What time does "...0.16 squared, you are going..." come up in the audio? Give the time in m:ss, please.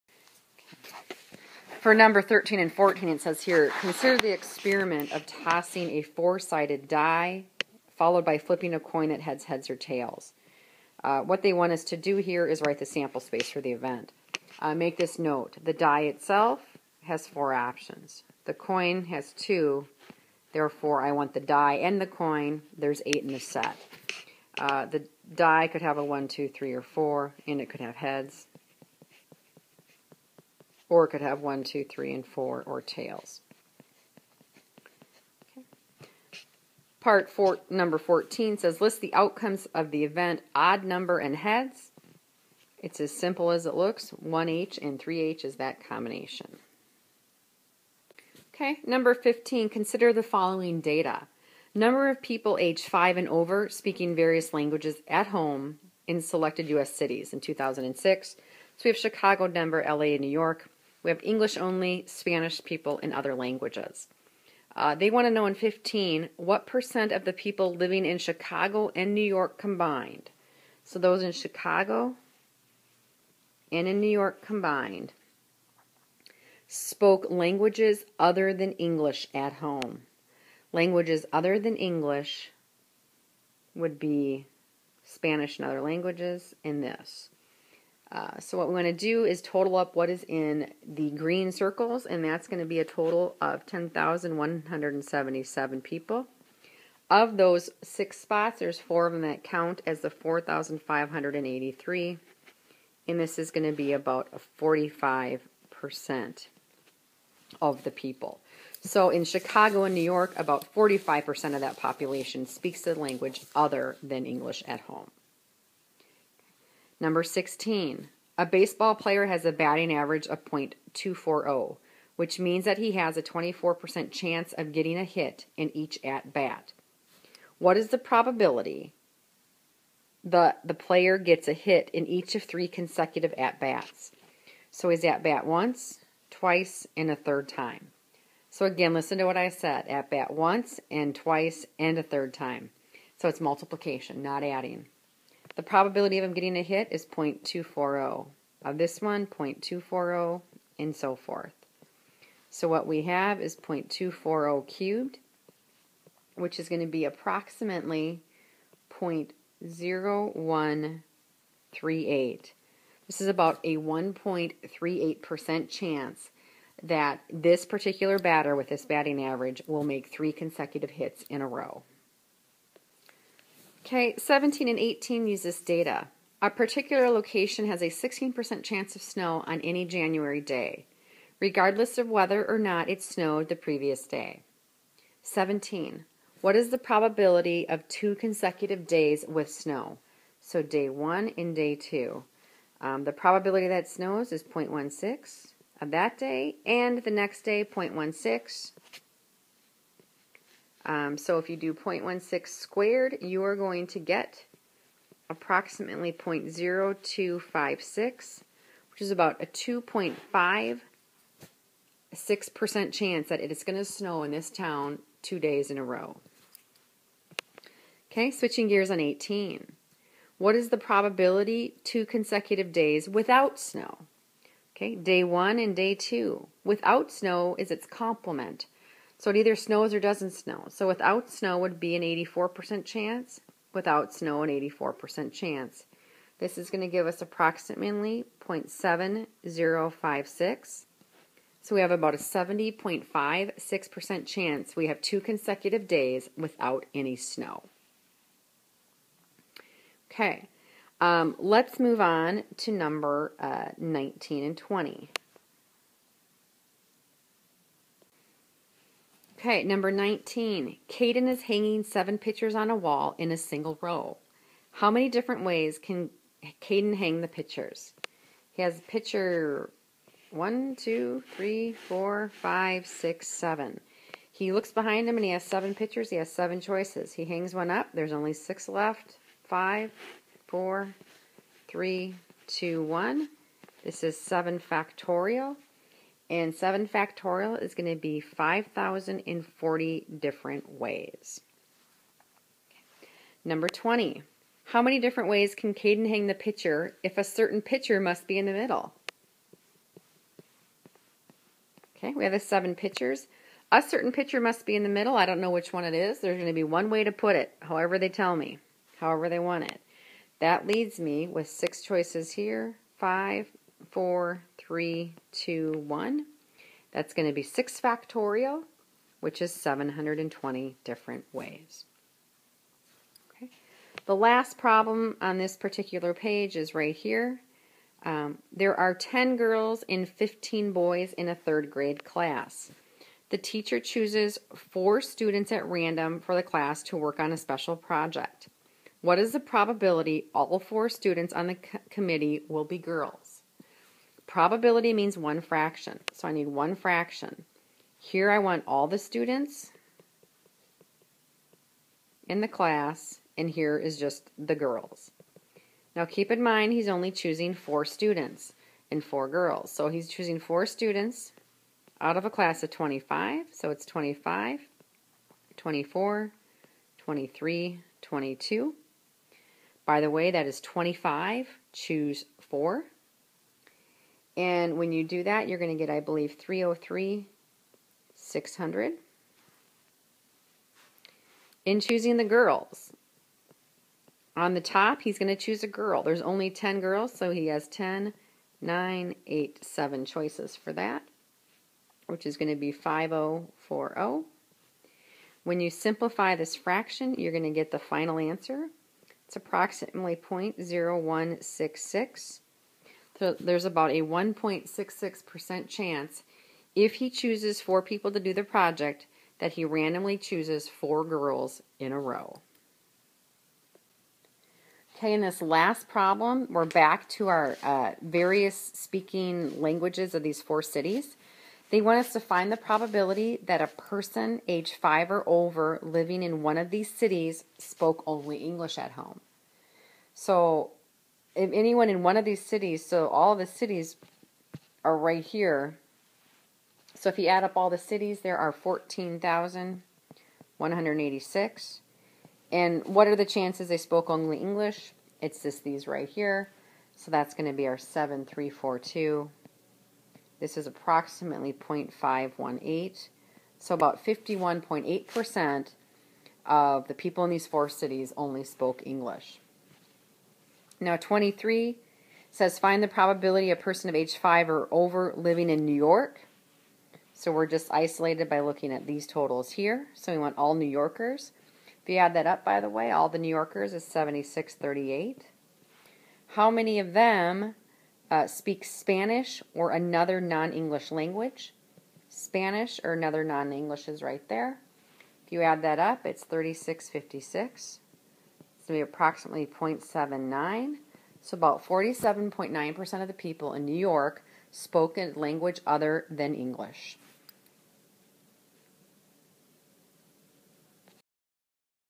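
3:21.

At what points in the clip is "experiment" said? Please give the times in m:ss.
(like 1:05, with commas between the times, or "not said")
0:04.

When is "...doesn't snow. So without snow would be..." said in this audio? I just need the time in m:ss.
3:49.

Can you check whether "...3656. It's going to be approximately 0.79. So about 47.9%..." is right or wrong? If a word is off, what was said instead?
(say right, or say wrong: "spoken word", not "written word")
right.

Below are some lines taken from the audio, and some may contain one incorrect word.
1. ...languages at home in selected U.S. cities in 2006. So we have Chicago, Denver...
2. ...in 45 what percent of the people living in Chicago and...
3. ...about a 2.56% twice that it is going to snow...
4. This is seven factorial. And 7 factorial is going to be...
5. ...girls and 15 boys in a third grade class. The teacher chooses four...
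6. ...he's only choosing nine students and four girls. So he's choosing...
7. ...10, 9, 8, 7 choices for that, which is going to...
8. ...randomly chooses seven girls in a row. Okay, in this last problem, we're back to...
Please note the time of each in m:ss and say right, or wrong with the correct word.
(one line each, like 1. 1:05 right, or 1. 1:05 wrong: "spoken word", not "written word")
1. 0:54 right
2. 1:05 wrong: "15", not "45"
3. 3:29 wrong: "chance", not "twice"
4. 4:43 right
5. 5:29 right
6. 5:56 wrong: "four", not "nine"
7. 6:27 right
8. 6:49 wrong: "four", not "seven".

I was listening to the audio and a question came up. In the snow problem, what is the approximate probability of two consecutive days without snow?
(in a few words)
0.7056.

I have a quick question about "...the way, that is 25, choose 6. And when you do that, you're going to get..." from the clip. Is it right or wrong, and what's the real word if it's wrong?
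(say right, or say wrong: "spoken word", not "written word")
wrong: "4", not "6".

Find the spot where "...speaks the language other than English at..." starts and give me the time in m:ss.
1:52.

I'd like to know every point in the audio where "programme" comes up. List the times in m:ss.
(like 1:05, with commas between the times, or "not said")
not said.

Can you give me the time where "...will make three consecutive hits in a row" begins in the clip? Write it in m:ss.
2:49.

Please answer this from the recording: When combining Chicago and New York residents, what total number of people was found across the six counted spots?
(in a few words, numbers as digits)
10,177.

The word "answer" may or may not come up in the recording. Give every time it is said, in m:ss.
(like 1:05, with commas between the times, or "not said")
6:38.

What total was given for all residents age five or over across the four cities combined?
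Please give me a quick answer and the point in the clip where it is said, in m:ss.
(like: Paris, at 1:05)
14,186, at 7:18.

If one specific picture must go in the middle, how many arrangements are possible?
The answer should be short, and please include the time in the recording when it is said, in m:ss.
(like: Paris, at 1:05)
720, at 5:19.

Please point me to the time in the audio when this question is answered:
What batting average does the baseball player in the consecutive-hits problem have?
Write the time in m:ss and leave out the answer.
2:00.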